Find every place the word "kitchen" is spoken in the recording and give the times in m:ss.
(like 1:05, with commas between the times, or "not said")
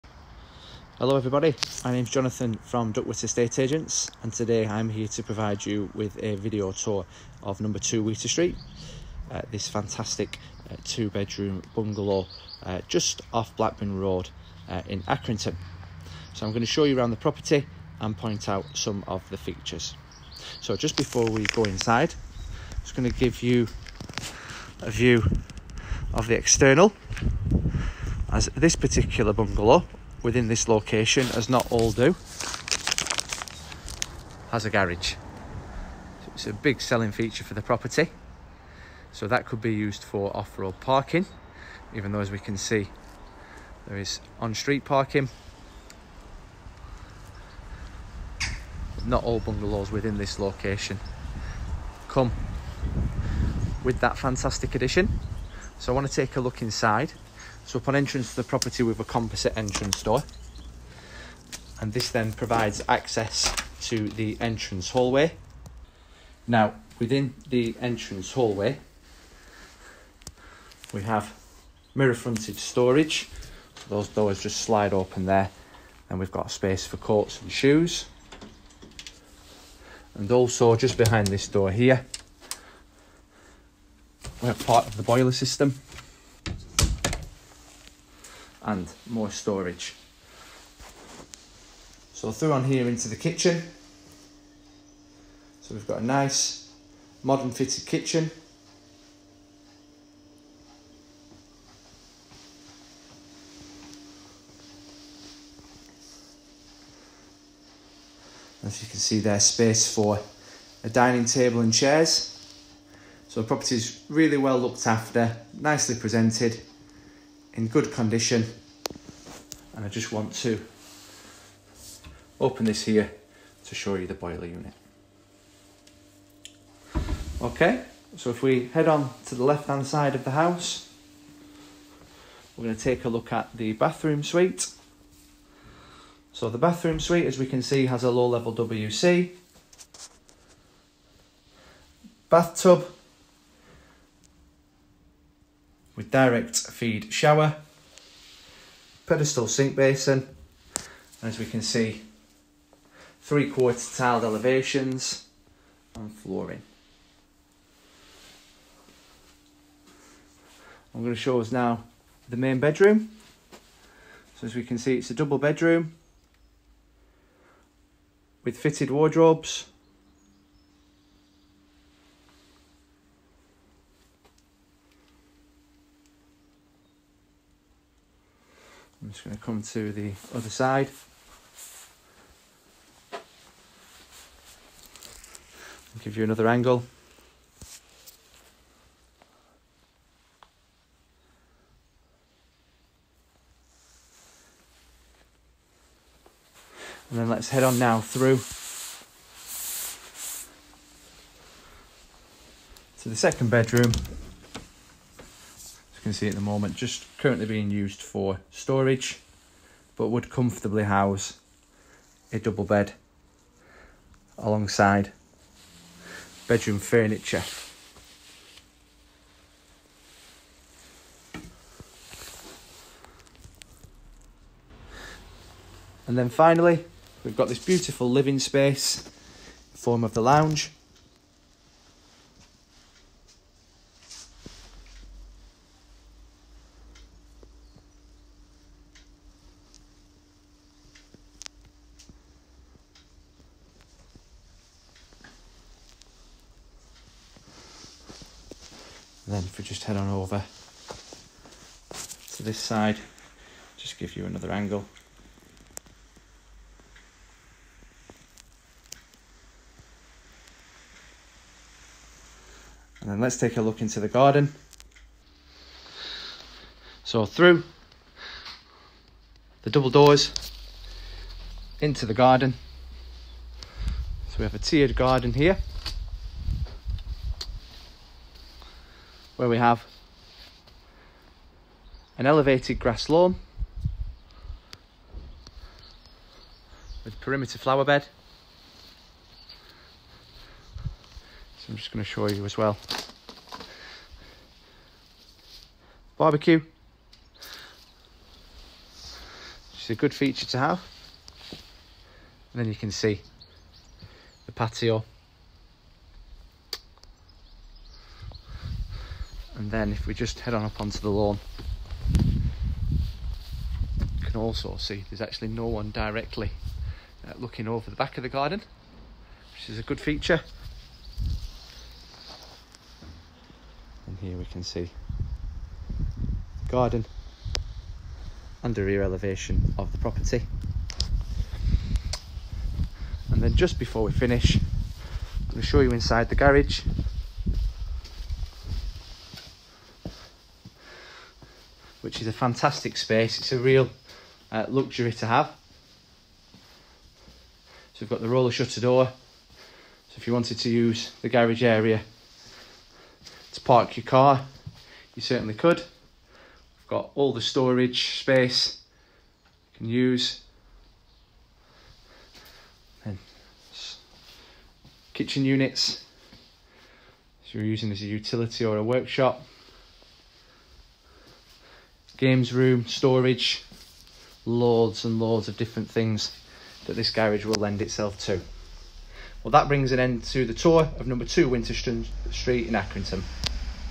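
1:33, 1:37, 6:05.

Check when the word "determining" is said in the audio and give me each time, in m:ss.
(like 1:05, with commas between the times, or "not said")
not said.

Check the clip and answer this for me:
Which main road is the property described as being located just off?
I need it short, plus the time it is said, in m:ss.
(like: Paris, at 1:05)
Blackburn Road, at 0:13.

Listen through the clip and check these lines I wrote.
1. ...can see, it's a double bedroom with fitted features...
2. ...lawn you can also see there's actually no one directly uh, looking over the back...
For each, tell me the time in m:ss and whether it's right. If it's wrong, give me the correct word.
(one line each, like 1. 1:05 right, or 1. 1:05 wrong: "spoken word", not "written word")
1. 2:44 wrong: "wardrobes", not "features"
2. 5:11 right.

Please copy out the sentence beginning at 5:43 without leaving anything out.
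It's a real uh, luxury to have.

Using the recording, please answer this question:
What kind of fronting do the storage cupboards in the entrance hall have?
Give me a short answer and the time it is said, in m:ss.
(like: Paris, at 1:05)
Mirror fronted, at 1:11.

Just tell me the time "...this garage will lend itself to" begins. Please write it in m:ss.
6:16.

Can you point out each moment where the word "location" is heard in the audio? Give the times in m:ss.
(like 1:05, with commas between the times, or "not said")
0:30, 0:50.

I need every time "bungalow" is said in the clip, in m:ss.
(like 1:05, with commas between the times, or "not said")
0:11, 0:29, 0:49.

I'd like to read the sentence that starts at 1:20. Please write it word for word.
And also just behind this door here, we have part of the boiler system and more storage.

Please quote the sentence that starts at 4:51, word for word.
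So I'm just going to show you as well.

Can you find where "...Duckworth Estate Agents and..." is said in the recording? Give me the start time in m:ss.
0:02.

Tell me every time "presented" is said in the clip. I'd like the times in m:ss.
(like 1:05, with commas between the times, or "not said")
1:55.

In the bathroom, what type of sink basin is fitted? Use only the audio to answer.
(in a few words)
Pedestal.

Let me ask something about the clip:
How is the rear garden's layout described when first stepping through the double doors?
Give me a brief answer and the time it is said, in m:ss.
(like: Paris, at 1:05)
Tiered, at 4:34.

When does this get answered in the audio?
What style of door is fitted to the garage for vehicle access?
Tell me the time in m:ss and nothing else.
5:48.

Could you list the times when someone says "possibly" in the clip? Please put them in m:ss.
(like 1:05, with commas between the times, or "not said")
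not said.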